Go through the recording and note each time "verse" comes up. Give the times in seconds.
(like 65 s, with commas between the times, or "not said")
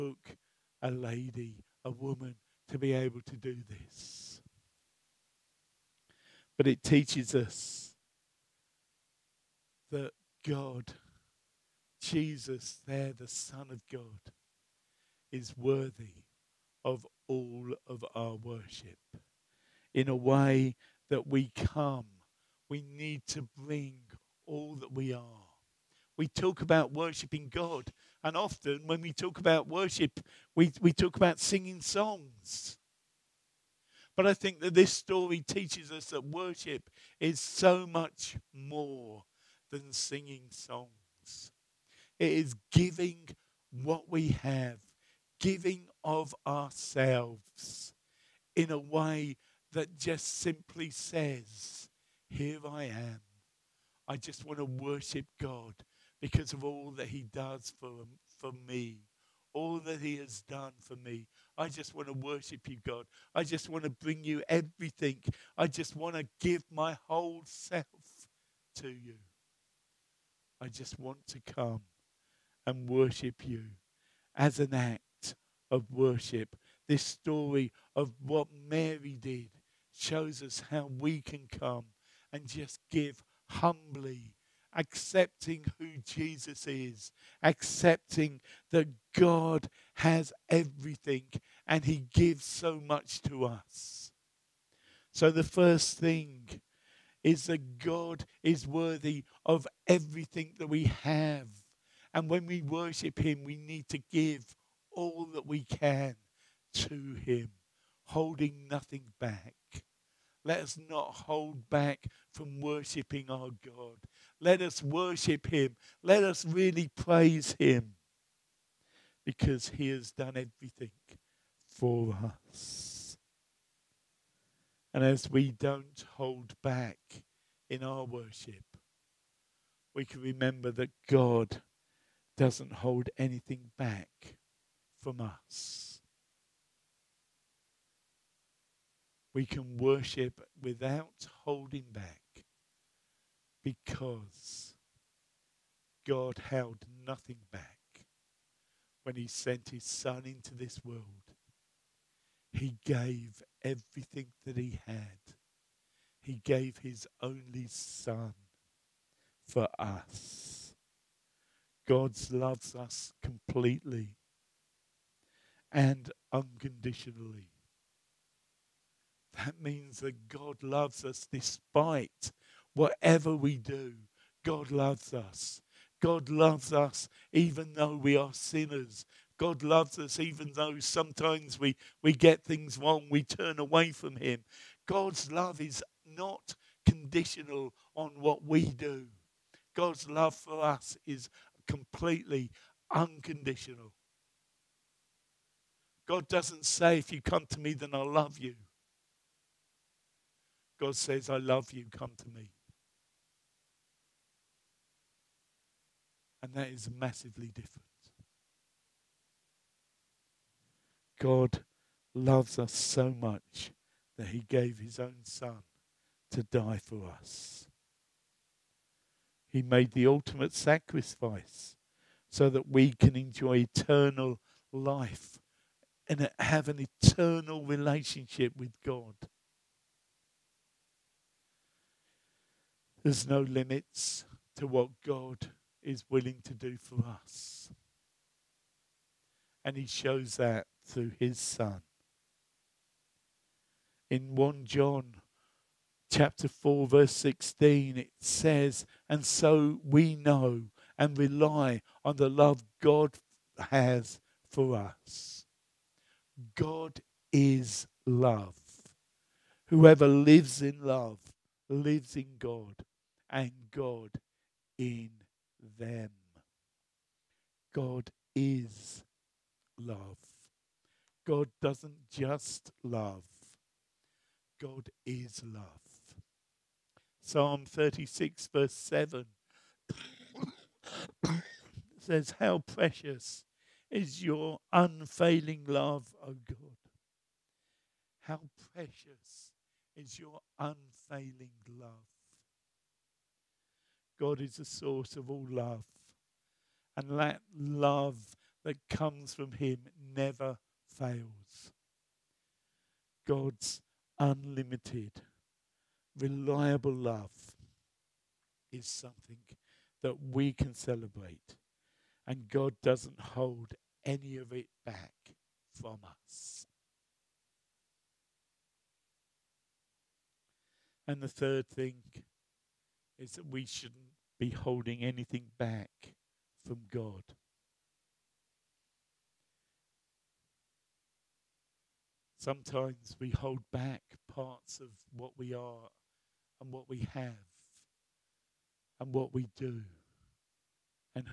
246 s, 278 s.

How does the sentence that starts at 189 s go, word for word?
God's love for us is completely unconditional.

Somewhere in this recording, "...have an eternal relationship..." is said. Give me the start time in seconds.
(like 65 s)
226 s.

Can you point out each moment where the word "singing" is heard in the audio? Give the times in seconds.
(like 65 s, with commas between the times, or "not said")
31 s, 39 s.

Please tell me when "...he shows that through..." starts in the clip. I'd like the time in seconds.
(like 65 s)
239 s.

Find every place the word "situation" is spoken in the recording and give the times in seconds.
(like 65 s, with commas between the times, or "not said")
not said.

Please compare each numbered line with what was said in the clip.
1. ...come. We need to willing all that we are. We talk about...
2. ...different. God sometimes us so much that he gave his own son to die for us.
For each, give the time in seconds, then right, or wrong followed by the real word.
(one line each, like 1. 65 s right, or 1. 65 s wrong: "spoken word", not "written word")
1. 21 s wrong: "bring", not "willing"
2. 207 s wrong: "loves", not "sometimes".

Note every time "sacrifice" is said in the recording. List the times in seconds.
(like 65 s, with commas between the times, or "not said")
220 s.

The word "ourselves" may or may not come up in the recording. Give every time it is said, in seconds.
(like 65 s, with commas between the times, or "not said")
46 s.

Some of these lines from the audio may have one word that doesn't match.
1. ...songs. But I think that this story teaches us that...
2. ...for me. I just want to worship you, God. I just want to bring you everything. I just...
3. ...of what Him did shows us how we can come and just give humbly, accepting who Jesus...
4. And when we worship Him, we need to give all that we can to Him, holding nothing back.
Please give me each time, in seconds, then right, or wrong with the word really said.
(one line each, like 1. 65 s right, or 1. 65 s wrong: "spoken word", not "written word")
1. 31 s right
2. 60 s right
3. 77 s wrong: "Mary", not "Him"
4. 102 s right.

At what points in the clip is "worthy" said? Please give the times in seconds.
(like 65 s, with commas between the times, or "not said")
15 s, 98 s.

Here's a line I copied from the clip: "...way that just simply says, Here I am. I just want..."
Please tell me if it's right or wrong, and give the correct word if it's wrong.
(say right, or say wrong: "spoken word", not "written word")
right.